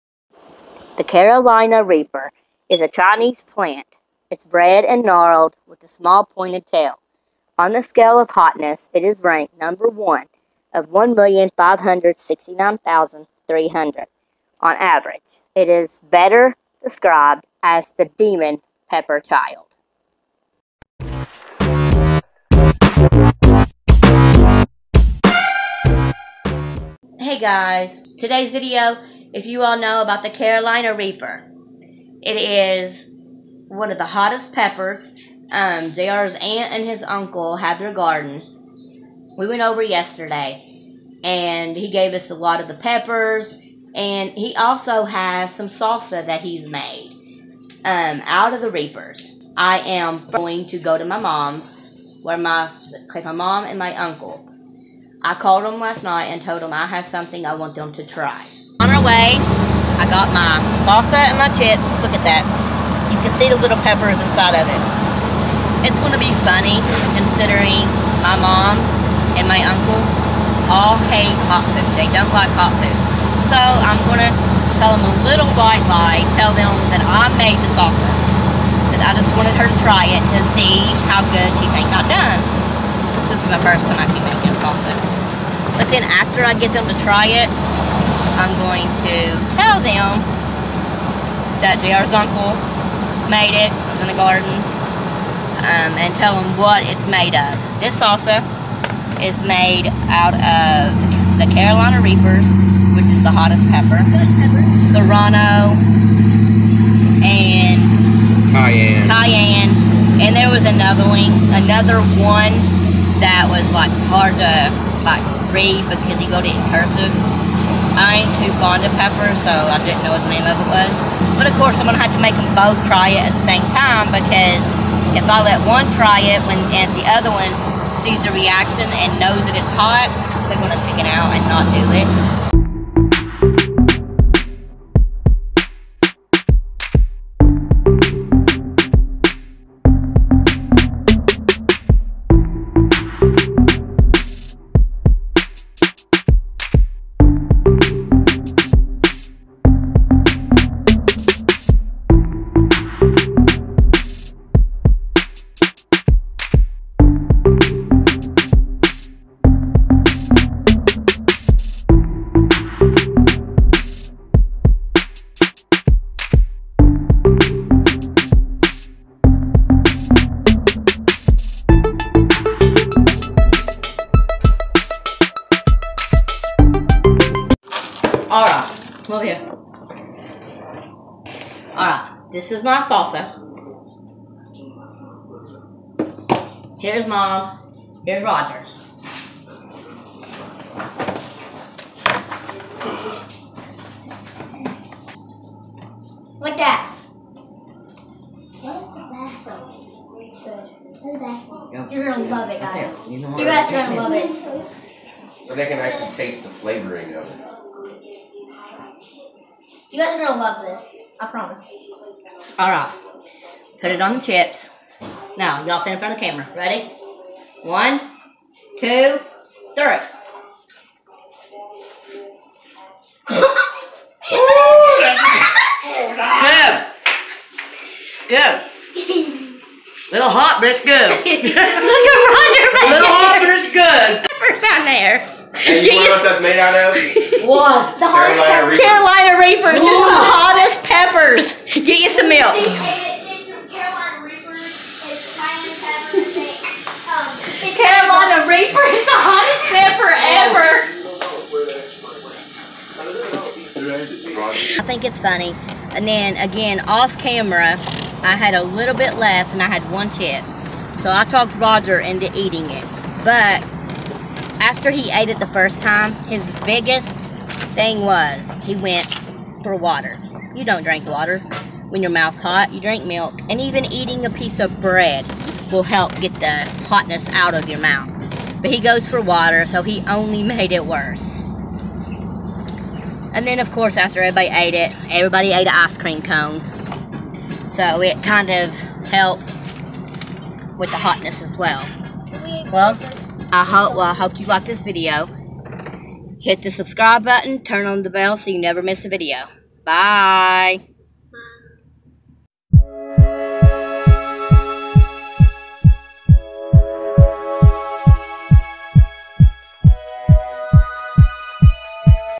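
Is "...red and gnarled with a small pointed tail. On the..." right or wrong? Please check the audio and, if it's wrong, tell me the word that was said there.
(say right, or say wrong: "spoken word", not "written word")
right.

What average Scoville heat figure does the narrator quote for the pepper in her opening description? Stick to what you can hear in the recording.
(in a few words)
1,569,300.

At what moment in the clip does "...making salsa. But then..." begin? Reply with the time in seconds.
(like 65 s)
84 s.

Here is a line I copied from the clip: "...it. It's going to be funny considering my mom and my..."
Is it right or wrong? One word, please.
right.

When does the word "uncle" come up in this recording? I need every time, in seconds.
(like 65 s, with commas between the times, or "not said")
37 s, 53 s, 69 s, 92 s.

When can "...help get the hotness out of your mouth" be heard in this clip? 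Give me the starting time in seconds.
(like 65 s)
275 s.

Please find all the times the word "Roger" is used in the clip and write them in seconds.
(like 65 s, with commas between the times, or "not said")
188 s, 232 s, 261 s.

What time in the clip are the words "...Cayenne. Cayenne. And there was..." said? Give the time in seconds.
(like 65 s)
108 s.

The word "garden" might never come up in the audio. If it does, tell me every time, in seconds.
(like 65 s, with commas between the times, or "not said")
37 s, 94 s.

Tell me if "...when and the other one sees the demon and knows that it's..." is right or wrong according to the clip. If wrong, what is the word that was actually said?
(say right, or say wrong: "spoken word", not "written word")
wrong: "reaction", not "demon".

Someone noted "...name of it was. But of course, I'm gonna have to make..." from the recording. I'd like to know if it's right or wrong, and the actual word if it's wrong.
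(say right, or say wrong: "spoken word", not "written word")
right.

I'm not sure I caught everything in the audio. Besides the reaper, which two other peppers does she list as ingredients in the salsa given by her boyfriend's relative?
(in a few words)
Serrano and Cayenne.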